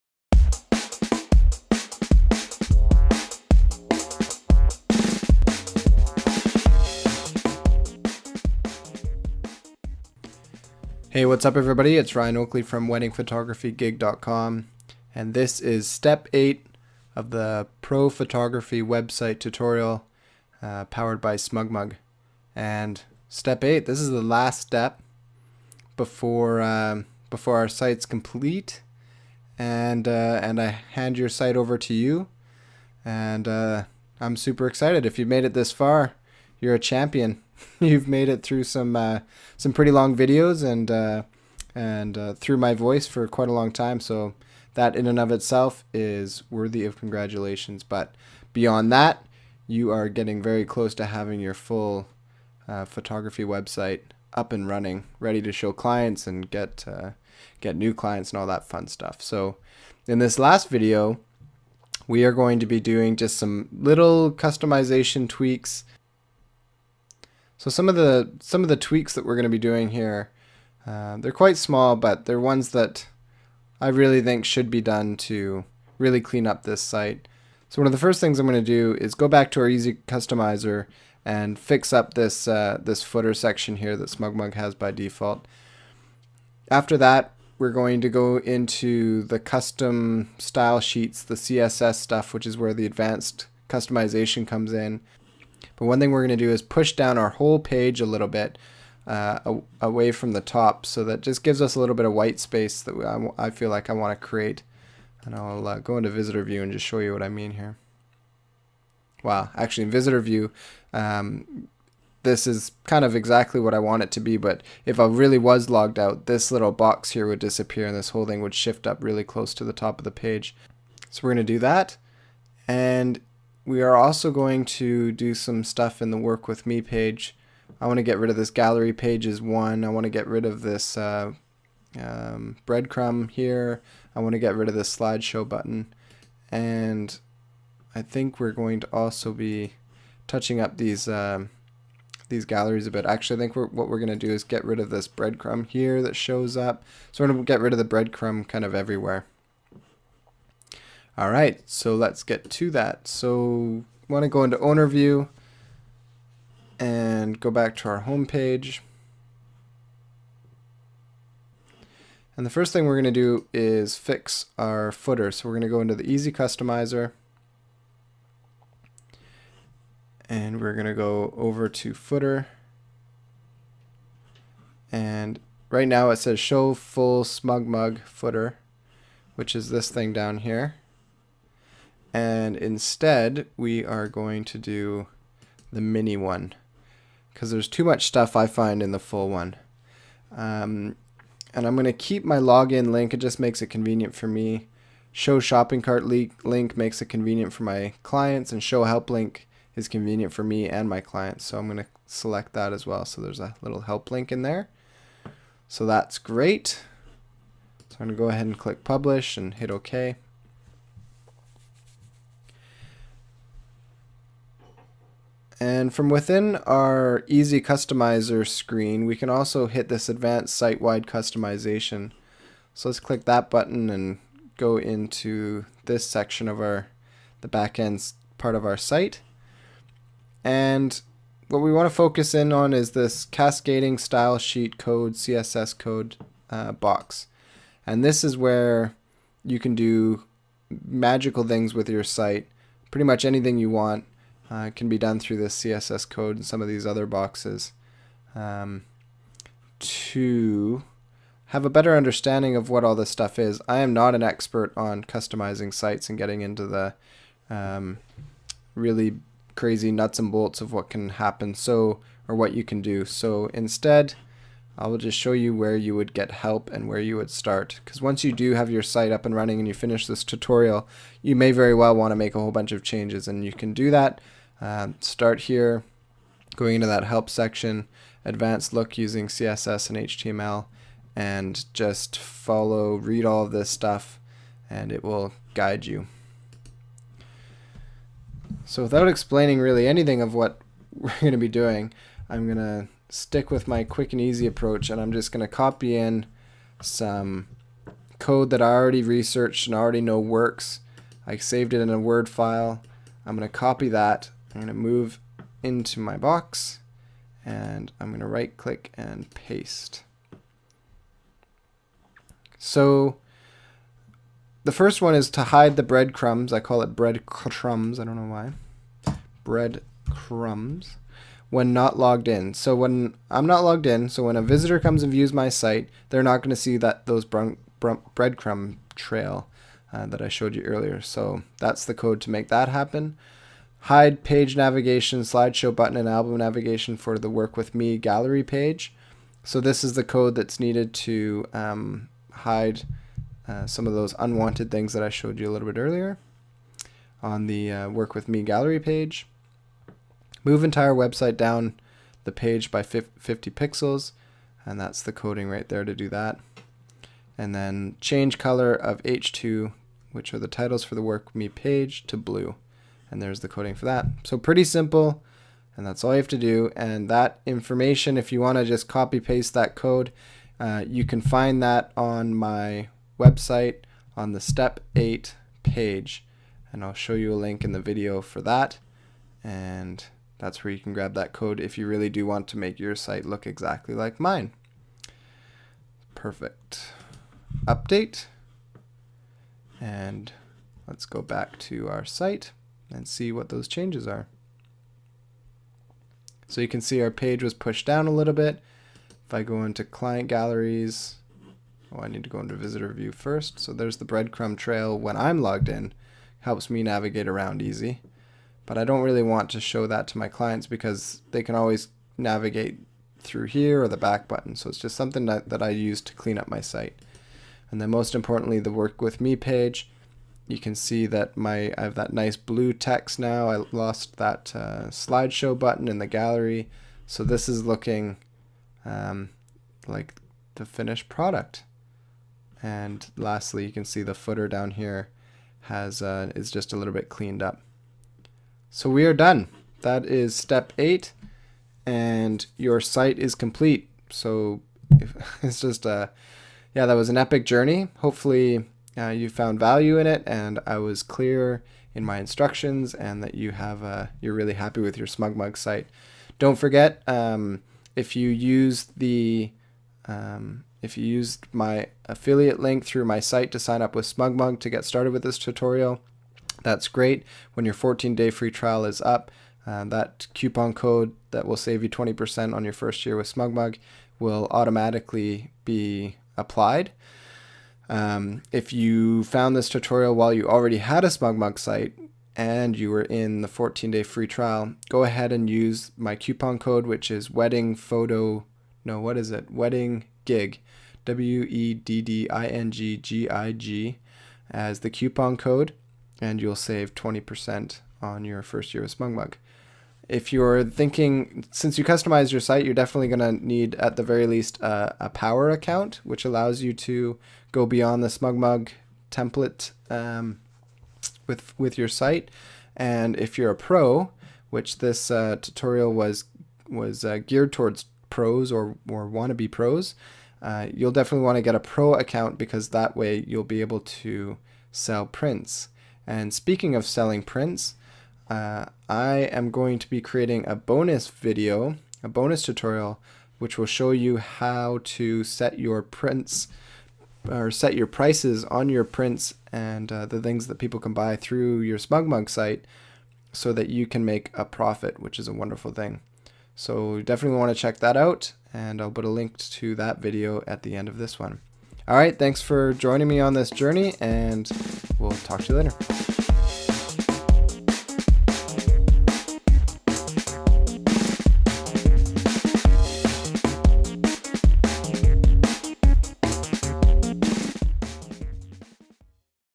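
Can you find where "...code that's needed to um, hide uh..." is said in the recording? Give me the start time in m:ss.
5:40.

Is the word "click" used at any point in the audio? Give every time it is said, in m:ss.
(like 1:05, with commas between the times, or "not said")
3:28, 3:42, 5:08.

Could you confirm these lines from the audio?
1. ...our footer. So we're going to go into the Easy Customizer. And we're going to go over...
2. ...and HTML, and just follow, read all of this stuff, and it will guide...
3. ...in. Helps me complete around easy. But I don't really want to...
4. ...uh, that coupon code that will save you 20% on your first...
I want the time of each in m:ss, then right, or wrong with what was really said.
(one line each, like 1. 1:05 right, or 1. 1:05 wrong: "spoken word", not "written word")
1. 2:44 right
2. 4:39 right
3. 6:45 wrong: "navigate", not "complete"
4. 7:49 right.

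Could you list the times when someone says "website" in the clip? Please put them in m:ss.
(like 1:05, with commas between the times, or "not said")
0:18, 0:53, 5:50, 6:13.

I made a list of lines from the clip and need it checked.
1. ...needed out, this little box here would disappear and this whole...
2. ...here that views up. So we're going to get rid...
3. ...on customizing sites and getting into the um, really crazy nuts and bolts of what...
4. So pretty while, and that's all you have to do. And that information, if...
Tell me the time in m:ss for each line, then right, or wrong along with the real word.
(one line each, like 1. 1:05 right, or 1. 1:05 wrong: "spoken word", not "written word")
1. 1:55 wrong: "logged", not "needed"
2. 2:25 wrong: "shows", not "views"
3. 4:14 right
4. 6:04 wrong: "simple", not "while".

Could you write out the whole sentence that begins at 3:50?
And what we want to focus in on is this cascading style sheet code CSS code uh, box.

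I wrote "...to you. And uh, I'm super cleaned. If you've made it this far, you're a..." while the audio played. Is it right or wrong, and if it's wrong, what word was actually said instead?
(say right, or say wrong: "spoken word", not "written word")
wrong: "excited", not "cleaned".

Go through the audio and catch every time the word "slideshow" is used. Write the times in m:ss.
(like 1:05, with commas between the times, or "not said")
2:14, 5:35, 7:04.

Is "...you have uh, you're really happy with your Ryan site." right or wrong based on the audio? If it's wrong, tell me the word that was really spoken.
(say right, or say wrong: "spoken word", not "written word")
wrong: "SmugMug", not "Ryan".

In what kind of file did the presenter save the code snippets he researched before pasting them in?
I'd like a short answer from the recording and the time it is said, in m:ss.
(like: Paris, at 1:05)
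Word file, at 5:01.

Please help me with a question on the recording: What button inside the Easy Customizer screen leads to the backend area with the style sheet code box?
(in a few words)
Advanced Site-Wide Customization.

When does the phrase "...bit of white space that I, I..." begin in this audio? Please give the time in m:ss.
1:41.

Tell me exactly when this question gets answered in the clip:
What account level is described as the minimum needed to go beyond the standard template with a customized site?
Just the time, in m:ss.
8:25.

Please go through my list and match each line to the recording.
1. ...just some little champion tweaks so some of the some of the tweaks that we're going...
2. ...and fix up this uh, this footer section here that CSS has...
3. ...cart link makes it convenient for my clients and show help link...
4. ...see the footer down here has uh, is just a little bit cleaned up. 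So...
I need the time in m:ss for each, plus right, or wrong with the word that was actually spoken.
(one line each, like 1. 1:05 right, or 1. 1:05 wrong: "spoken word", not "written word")
1. 1:03 wrong: "customization", not "champion"
2. 1:21 wrong: "SmugMug", not "CSS"
3. 3:15 right
4. 7:13 right.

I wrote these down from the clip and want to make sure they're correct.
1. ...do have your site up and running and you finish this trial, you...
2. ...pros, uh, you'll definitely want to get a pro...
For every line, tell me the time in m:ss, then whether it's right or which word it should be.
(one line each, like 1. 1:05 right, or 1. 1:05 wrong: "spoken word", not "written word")
1. 4:28 wrong: "tutorial", not "trial"
2. 8:39 right.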